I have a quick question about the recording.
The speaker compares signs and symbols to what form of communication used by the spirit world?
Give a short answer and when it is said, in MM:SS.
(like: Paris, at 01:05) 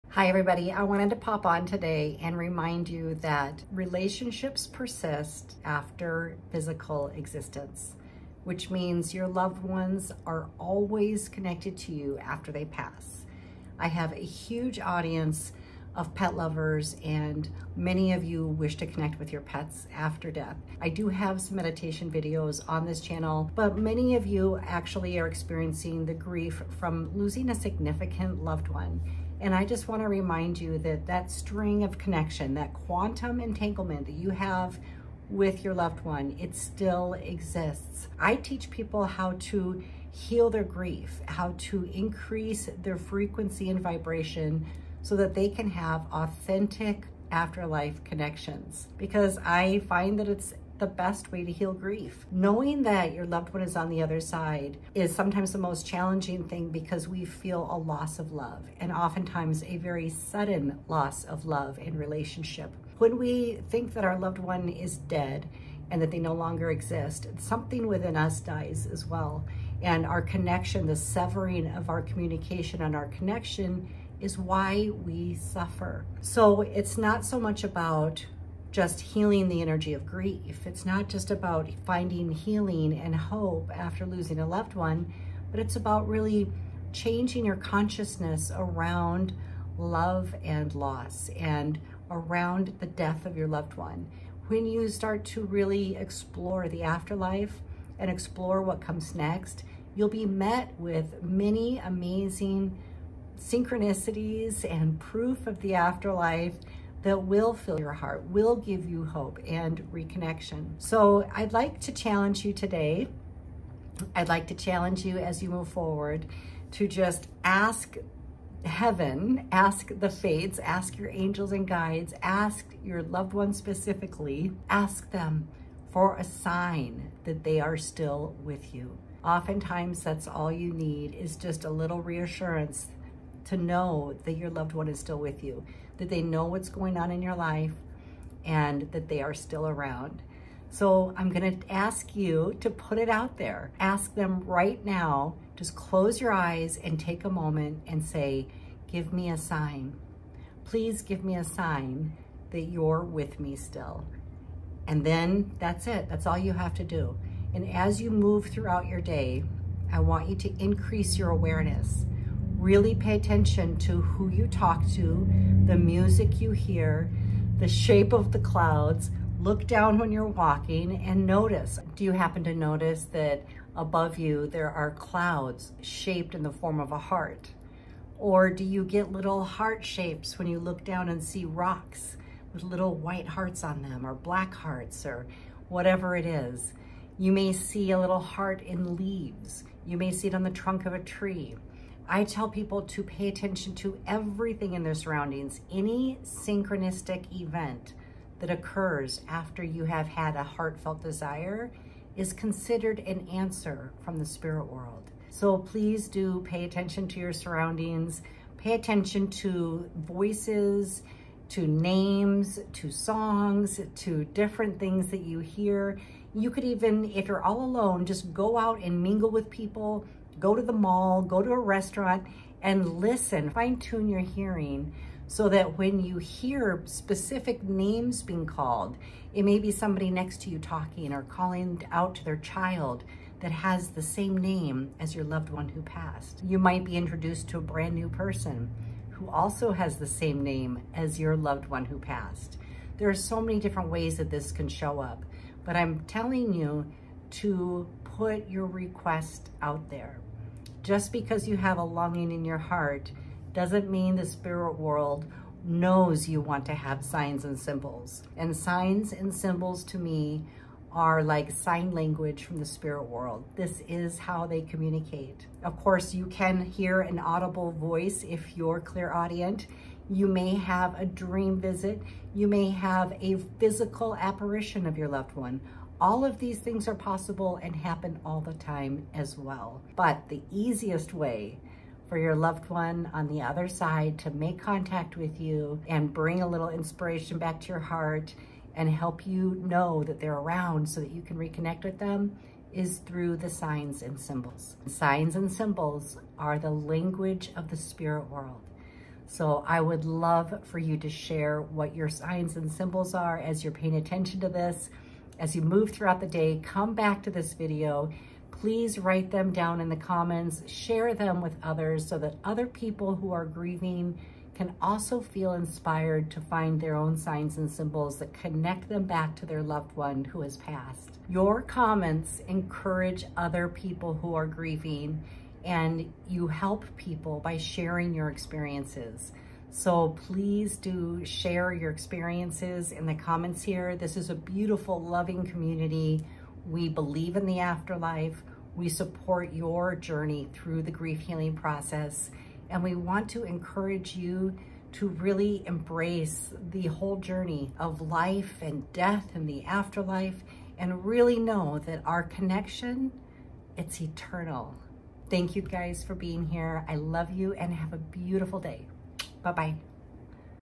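sign language, at 04:21.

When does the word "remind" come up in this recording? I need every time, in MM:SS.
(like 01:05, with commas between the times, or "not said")
00:02, 00:30.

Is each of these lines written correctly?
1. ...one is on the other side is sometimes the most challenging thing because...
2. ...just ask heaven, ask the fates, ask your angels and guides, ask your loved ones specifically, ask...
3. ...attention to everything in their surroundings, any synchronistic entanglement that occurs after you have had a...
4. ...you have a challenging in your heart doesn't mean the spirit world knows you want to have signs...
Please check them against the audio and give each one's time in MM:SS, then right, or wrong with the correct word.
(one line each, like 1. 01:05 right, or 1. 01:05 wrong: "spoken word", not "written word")
1. 00:53 right
2. 01:56 right
3. 03:13 wrong: "event", not "entanglement"
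4. 04:11 wrong: "longing", not "challenging".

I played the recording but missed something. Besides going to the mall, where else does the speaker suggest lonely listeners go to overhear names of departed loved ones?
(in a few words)
a restaurant.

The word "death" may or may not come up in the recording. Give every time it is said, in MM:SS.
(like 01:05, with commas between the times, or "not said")
00:20, 01:32, 05:48.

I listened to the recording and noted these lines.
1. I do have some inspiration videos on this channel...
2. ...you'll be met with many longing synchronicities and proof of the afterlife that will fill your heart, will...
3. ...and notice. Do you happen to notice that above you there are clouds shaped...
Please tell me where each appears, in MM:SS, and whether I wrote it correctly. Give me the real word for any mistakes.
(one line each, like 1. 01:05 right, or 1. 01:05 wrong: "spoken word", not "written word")
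1. 00:20 wrong: "meditation", not "inspiration"
2. 01:39 wrong: "amazing", not "longing"
3. 02:51 right.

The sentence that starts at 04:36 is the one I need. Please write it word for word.
All of these things are possible and happen all the time as well.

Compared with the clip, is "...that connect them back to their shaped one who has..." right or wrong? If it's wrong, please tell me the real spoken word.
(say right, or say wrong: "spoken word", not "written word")
wrong: "loved", not "shaped".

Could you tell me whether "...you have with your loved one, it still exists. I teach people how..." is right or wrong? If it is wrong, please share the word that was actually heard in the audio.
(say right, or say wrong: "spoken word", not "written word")
right.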